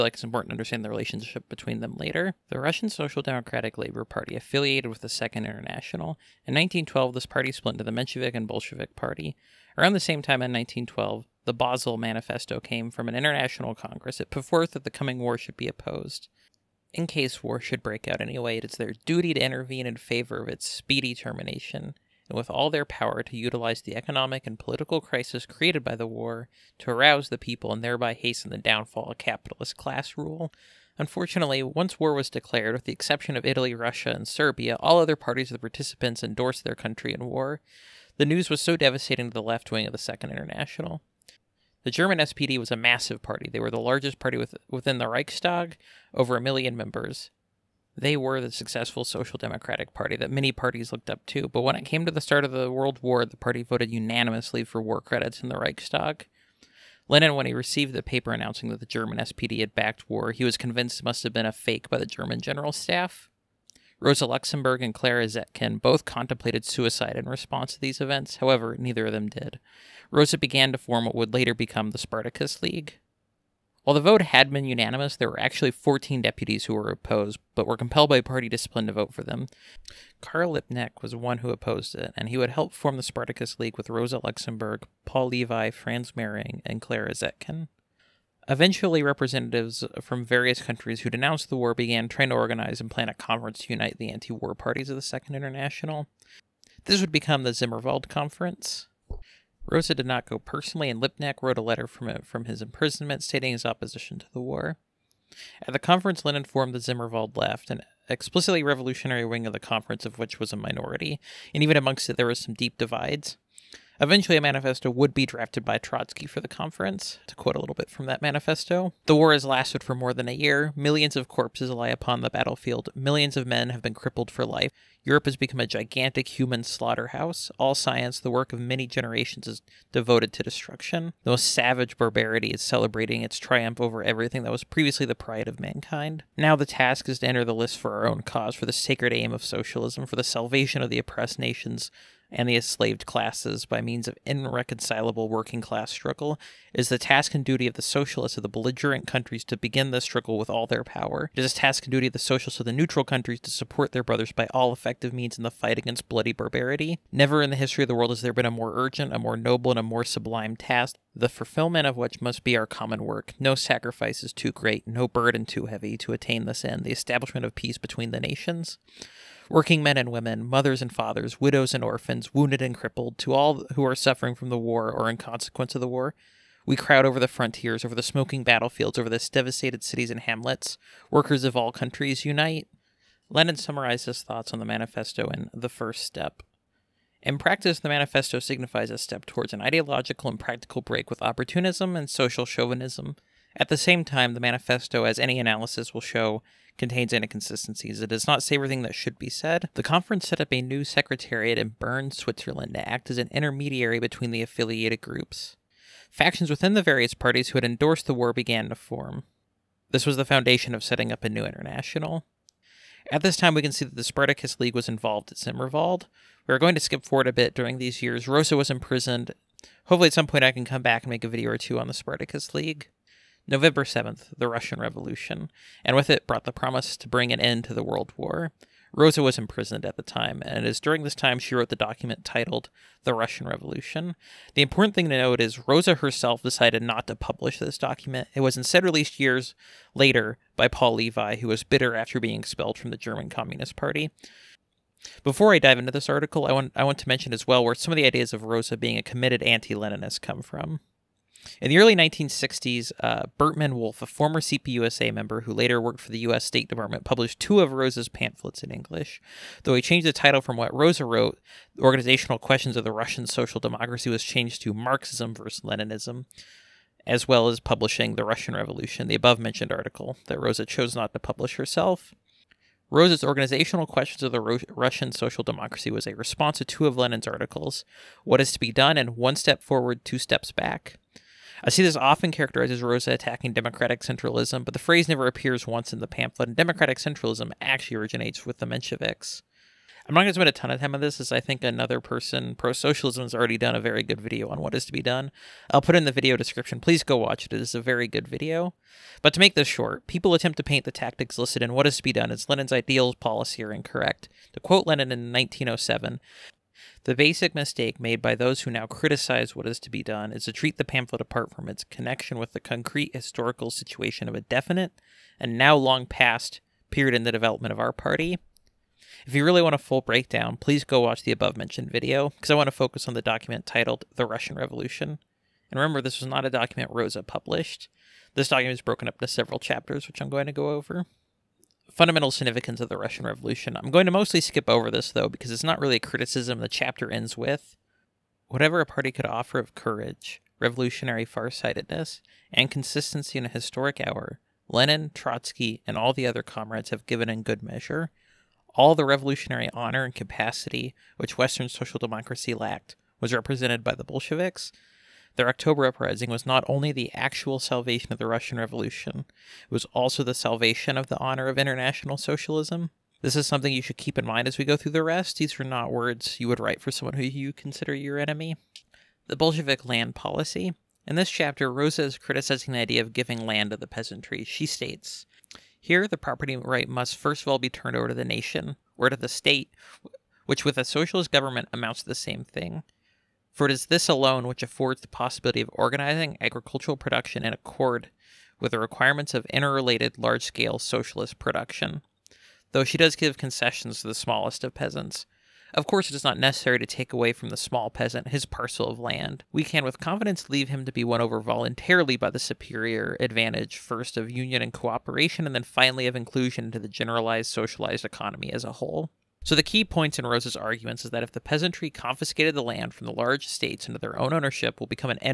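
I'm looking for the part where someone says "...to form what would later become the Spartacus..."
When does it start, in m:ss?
1:10.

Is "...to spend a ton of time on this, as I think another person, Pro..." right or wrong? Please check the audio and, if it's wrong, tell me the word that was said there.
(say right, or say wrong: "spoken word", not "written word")
right.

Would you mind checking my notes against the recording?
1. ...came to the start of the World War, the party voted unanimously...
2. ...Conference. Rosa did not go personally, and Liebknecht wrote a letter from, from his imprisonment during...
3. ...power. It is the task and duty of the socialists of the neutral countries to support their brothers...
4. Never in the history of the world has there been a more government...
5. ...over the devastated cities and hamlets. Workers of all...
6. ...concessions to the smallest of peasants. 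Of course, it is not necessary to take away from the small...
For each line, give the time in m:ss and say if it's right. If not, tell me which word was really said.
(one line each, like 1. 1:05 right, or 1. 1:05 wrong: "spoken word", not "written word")
1. 0:51 right
2. 1:38 wrong: "stating", not "during"
3. 2:30 right
4. 2:37 wrong: "urgent", not "government"
5. 2:58 right
6. 6:33 right.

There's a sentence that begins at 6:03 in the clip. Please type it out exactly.
This is something you should keep in mind as we go through the rest.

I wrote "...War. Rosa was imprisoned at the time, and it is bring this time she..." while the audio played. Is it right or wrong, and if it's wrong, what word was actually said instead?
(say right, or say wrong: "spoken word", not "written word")
wrong: "during", not "bring".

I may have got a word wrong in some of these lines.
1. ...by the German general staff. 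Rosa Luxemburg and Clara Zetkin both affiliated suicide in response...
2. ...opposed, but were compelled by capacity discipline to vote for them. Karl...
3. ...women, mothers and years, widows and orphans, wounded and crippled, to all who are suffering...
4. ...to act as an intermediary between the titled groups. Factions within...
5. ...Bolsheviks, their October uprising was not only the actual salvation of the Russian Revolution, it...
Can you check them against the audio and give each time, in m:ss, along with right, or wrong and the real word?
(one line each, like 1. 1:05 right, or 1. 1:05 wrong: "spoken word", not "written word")
1. 1:01 wrong: "contemplated", not "affiliated"
2. 1:16 wrong: "party", not "capacity"
3. 2:50 wrong: "fathers", not "years"
4. 3:22 wrong: "affiliated", not "titled"
5. 5:54 right.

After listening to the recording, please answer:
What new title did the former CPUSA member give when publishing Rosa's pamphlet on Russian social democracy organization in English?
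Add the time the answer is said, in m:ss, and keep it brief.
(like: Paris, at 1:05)
Marxism versus Leninism, at 4:24.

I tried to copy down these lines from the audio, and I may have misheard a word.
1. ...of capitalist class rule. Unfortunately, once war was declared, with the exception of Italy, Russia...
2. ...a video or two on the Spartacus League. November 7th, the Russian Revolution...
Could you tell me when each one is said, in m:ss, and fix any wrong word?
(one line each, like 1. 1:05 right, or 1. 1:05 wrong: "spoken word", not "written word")
1. 0:29 right
2. 3:41 right.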